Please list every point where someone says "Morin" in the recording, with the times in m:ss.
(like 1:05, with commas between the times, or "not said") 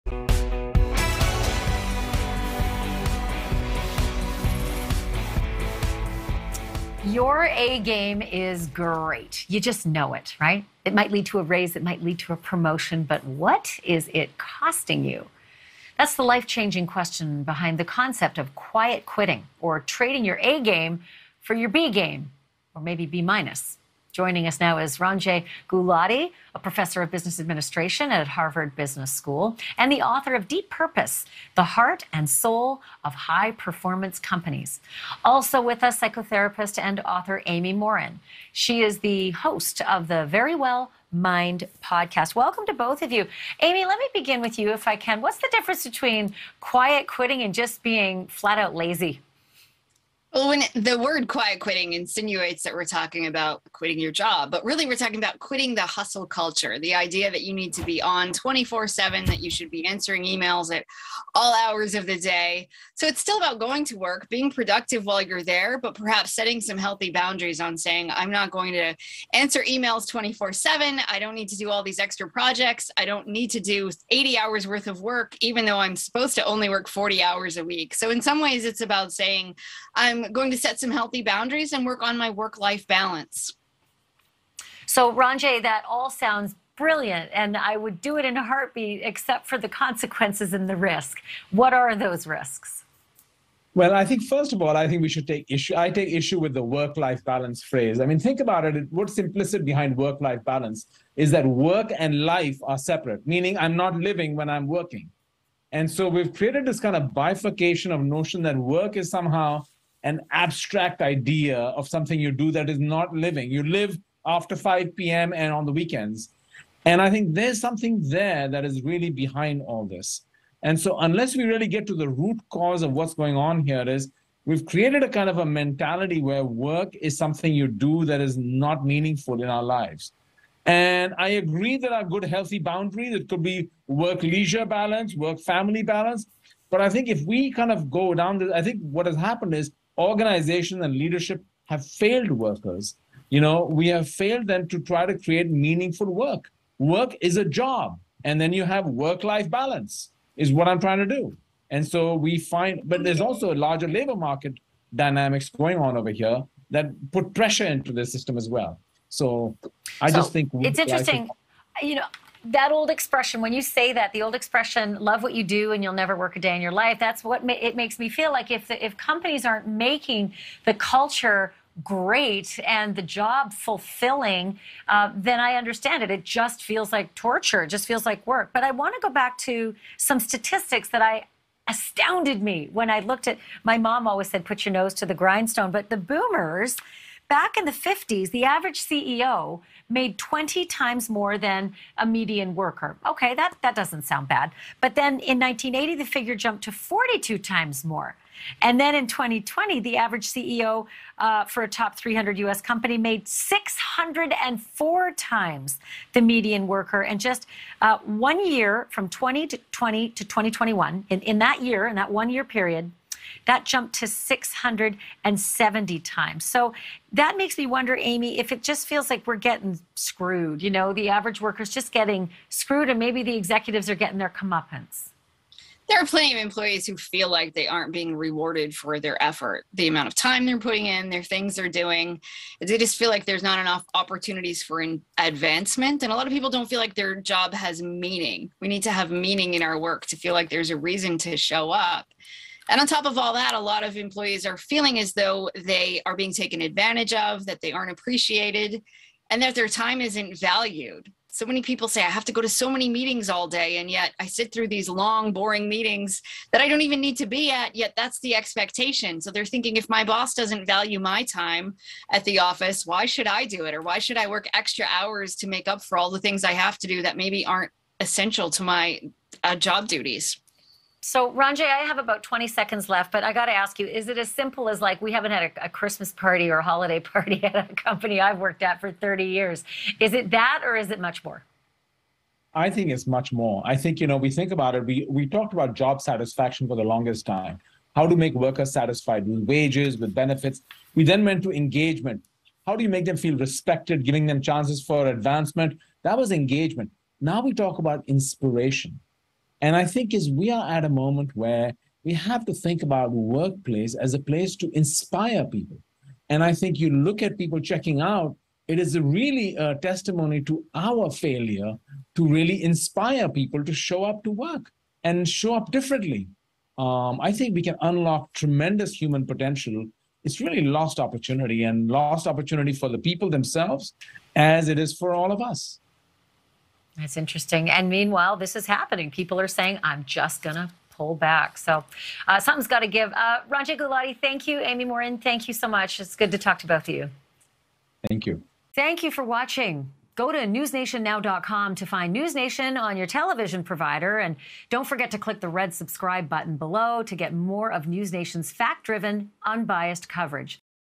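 0:37, 5:34.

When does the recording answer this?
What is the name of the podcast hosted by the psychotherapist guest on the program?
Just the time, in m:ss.
0:40.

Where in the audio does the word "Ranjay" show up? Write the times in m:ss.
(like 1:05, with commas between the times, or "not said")
0:24, 1:25, 4:31, 5:33.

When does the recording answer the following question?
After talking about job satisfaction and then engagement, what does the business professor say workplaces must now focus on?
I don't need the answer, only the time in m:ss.
4:58.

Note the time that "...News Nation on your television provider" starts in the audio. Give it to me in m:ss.
5:42.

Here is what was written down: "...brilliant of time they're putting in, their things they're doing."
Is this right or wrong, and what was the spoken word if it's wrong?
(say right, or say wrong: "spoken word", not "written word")
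wrong: "amount", not "brilliant".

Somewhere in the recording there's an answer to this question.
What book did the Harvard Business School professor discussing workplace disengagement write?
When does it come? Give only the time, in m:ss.
0:30.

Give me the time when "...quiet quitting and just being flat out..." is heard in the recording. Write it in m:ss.
0:46.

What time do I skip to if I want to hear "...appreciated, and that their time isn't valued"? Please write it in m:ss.
4:07.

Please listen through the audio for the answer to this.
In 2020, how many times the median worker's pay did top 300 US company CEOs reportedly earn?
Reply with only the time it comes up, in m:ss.
3:23.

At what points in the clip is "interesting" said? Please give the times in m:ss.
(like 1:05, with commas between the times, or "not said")
2:40, 5:27.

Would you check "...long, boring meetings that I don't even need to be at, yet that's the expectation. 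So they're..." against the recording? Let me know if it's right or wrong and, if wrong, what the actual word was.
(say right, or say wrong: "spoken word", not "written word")
right.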